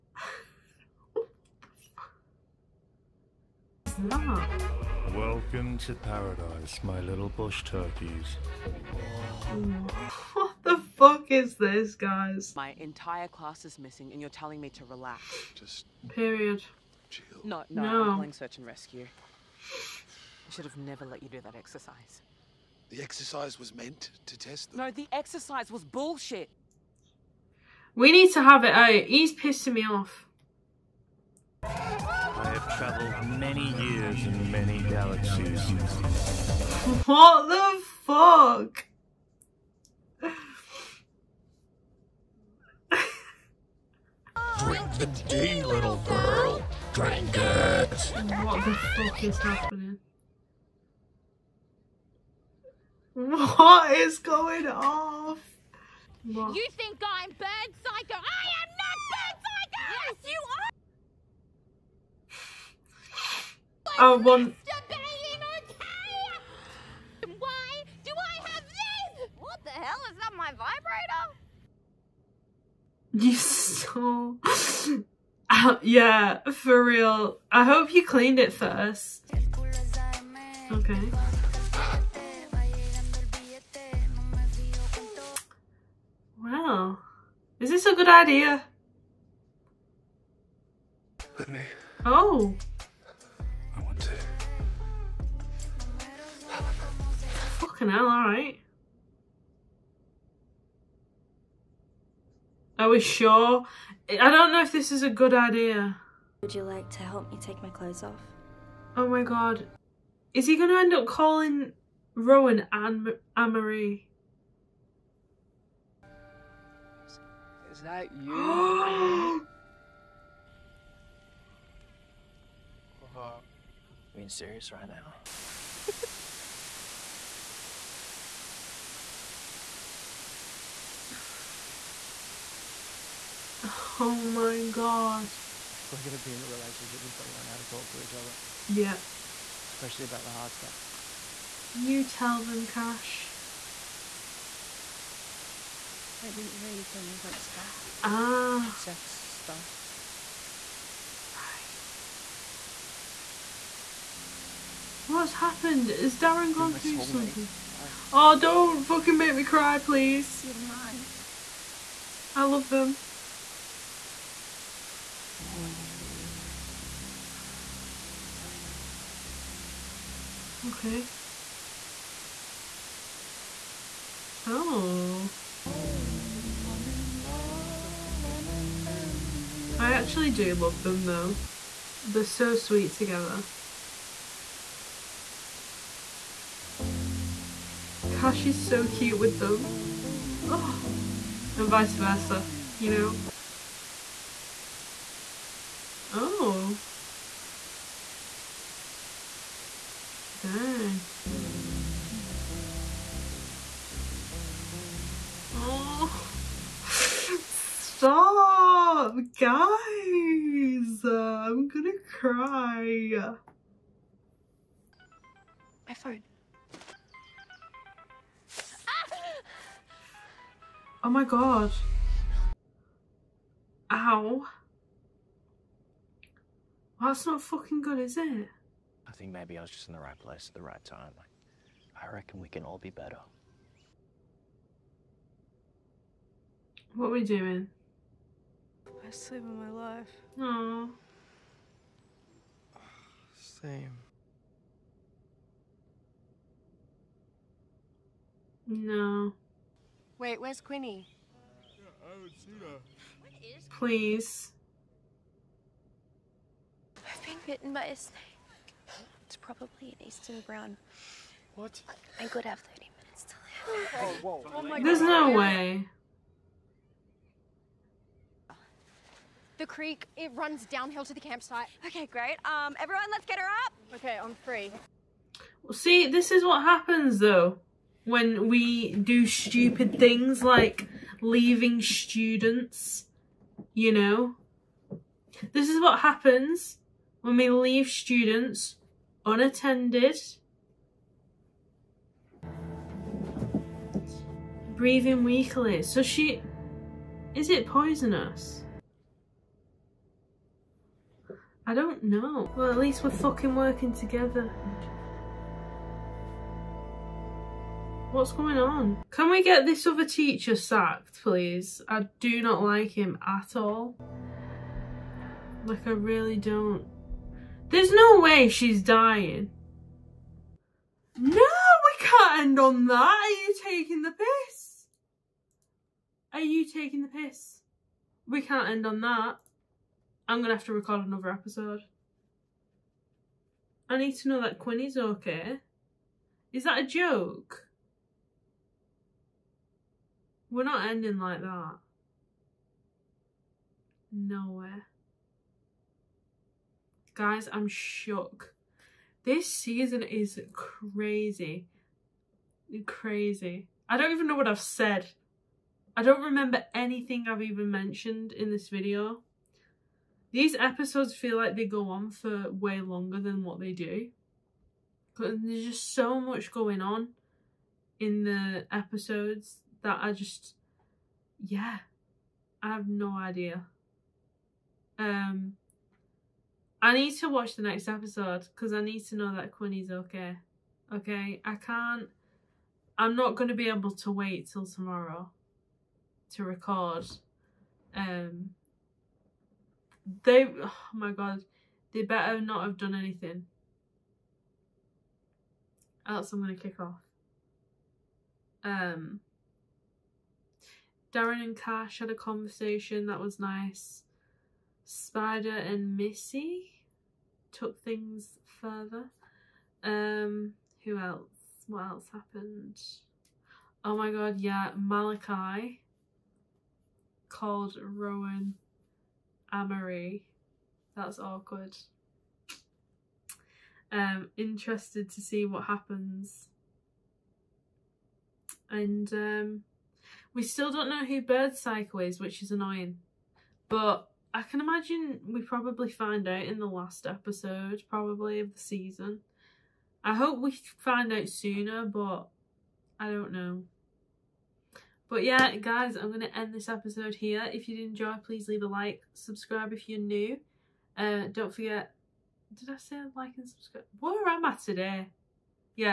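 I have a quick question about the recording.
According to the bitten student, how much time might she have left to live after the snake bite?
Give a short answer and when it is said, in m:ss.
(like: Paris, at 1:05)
30 minutes, at 4:22.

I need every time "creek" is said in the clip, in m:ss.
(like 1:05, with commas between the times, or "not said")
4:29.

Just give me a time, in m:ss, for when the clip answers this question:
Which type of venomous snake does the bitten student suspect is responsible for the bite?
4:20.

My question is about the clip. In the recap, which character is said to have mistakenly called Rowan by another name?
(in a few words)
Malakai.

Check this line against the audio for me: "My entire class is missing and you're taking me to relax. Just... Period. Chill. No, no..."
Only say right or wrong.
wrong.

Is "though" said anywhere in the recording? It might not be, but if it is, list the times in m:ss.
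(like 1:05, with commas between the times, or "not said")
3:01, 4:37.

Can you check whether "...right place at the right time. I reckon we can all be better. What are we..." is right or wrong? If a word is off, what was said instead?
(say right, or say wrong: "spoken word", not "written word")
right.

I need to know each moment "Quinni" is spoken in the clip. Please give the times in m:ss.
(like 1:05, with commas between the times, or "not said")
4:10, 5:34, 6:19.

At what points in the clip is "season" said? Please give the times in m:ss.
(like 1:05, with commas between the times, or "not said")
5:49, 7:18.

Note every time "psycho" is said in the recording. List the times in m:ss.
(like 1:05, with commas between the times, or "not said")
0:57, 7:11.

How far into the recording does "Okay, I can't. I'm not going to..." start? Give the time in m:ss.
6:20.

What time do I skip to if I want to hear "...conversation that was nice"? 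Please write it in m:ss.
6:42.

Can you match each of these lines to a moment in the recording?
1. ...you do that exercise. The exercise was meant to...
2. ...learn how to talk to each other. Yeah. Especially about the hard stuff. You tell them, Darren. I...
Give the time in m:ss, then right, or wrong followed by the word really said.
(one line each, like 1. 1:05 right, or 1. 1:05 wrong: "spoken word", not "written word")
1. 0:21 right
2. 2:17 wrong: "Cash", not "Darren".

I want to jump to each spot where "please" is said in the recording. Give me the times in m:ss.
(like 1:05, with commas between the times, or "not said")
2:39, 4:13, 5:11, 7:28.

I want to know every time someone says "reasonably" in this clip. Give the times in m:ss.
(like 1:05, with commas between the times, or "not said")
not said.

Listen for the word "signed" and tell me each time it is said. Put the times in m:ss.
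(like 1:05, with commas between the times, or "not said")
not said.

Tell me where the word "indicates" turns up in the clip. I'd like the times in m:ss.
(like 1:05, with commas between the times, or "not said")
not said.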